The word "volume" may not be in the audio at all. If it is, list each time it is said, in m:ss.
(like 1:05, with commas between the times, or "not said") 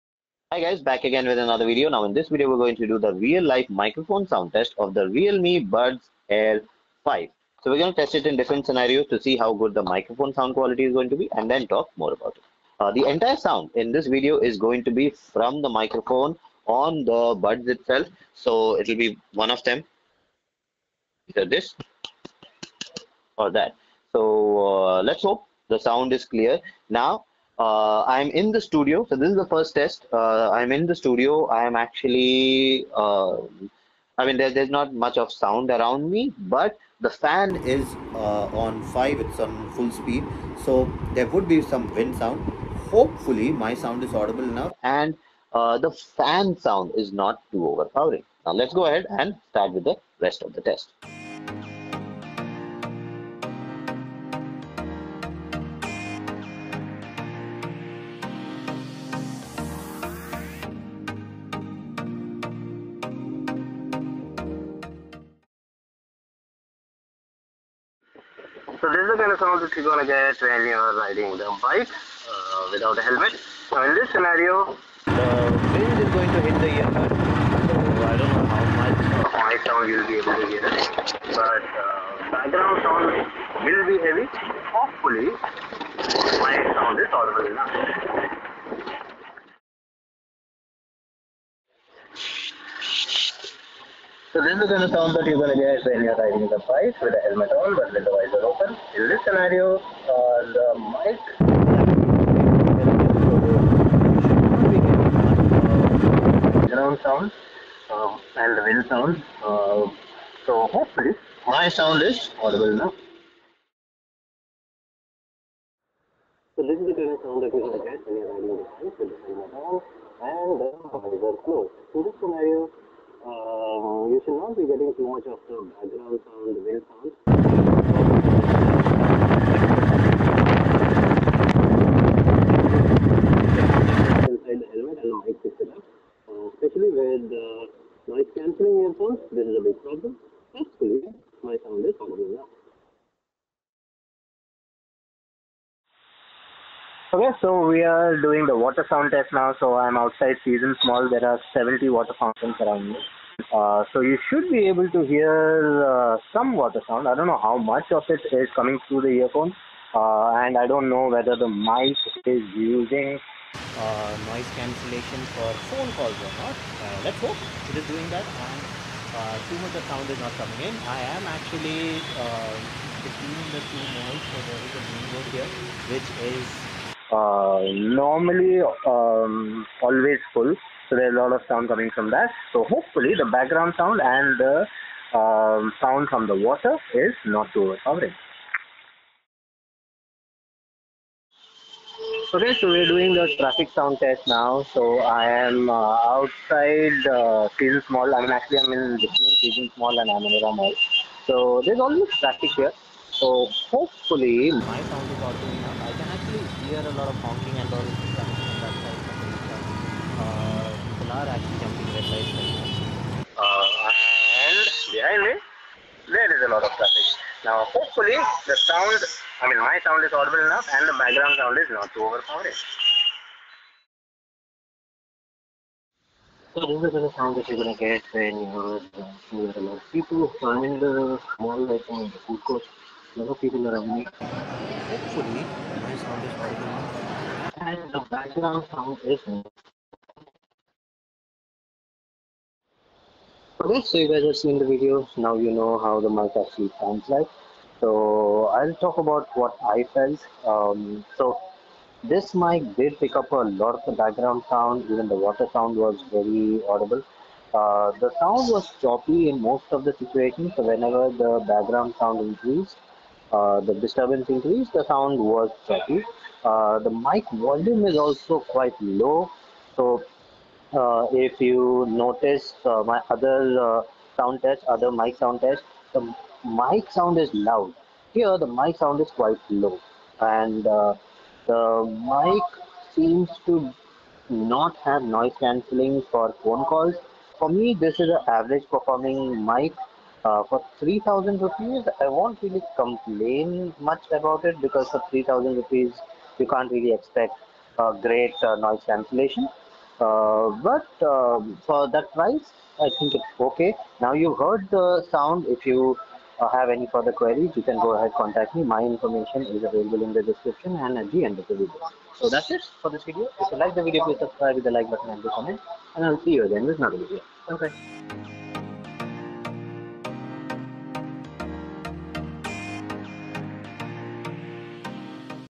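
4:27.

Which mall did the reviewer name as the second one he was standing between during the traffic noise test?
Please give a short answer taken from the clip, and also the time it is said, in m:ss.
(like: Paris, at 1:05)
Amanora Mall, at 3:20.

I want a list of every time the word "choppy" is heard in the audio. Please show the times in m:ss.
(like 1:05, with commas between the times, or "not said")
4:18, 4:25.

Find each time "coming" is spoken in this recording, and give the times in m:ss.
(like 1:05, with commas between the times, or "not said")
2:38, 2:50, 3:01.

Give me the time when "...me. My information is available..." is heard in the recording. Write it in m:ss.
5:08.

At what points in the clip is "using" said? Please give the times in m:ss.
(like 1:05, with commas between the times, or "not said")
2:42.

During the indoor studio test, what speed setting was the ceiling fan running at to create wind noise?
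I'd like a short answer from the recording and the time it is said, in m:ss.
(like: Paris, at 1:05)
5, at 0:38.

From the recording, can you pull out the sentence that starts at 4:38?
Here the mic sound is quite low and the mic seems to not have noise cancelling for phone calls.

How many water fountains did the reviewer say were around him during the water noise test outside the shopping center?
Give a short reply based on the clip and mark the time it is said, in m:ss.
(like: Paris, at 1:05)
70, at 2:31.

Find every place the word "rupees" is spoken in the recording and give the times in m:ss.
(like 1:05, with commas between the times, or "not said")
4:51, 4:55.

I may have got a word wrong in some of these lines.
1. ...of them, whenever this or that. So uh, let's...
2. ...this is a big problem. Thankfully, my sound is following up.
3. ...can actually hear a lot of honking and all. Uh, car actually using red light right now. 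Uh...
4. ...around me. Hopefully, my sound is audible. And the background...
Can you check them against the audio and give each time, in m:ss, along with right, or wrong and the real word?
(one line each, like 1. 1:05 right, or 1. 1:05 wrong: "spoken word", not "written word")
1. 0:19 wrong: "either", not "whenever"
2. 2:19 right
3. 3:25 wrong: "jumping", not "using"
4. 3:53 right.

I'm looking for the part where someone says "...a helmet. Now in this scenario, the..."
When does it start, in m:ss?
1:12.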